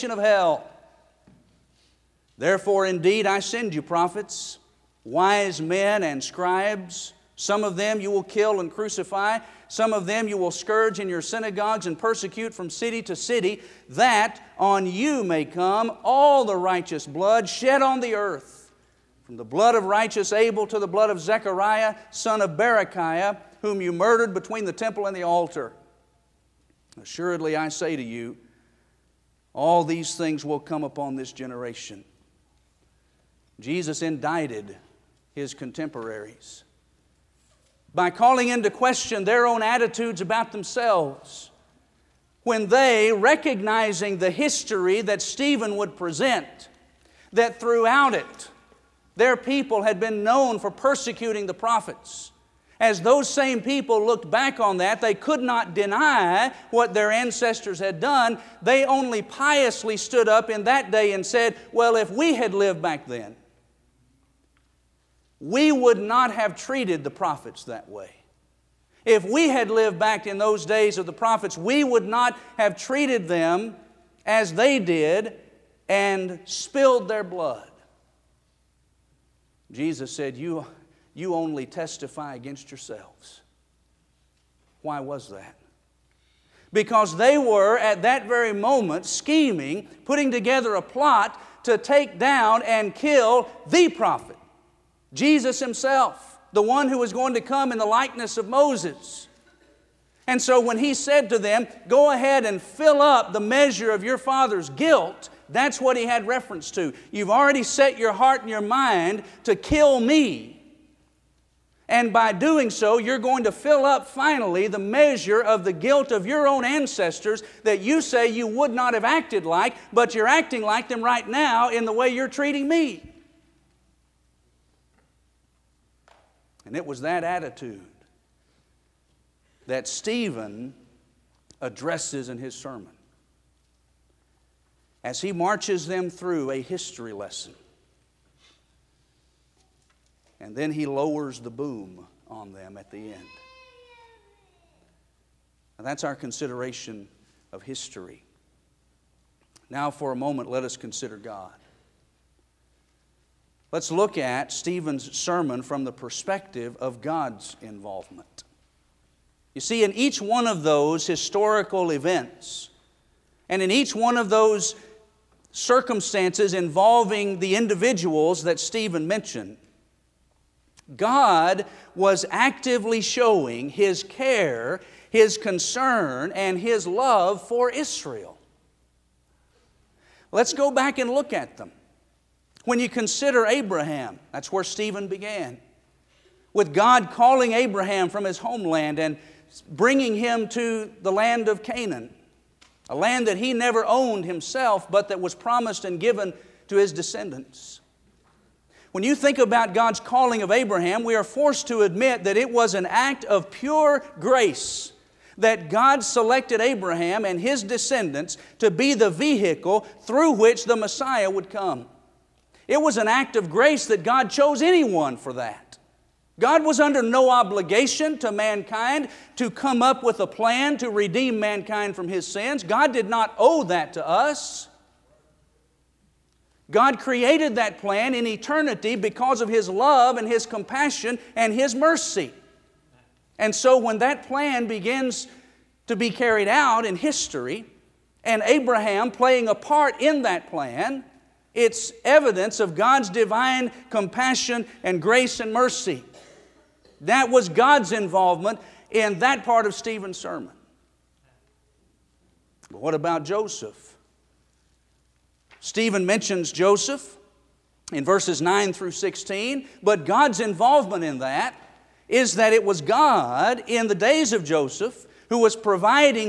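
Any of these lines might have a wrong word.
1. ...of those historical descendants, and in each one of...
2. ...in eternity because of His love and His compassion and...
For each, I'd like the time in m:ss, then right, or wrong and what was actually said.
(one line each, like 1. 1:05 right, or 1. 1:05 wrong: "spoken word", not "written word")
1. 2:40 wrong: "events", not "descendants"
2. 3:48 right.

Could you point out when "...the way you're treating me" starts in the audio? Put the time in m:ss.
2:01.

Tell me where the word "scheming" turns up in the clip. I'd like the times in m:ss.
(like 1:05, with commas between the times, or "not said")
1:29.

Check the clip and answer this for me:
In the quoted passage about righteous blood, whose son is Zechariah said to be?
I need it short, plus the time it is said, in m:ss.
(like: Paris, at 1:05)
Berechiah, at 0:22.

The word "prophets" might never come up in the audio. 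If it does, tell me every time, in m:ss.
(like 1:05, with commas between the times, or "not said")
0:03, 0:51, 1:07, 1:11, 1:33.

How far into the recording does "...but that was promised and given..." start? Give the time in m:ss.
3:14.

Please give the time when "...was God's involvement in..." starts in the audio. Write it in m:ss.
4:07.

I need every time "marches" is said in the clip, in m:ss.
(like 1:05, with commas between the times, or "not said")
2:15.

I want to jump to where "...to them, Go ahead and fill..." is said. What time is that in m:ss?
1:41.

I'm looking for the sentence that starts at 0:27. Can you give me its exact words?
Assuredly, I say to you, all these things will come upon this generation.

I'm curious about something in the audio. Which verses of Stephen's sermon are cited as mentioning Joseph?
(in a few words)
Verses 9 through 16.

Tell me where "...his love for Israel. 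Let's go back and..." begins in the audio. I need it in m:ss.
2:56.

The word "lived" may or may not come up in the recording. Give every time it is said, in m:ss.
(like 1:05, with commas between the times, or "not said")
1:02, 1:09.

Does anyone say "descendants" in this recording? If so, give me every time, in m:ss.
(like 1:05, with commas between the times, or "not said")
3:16, 3:27.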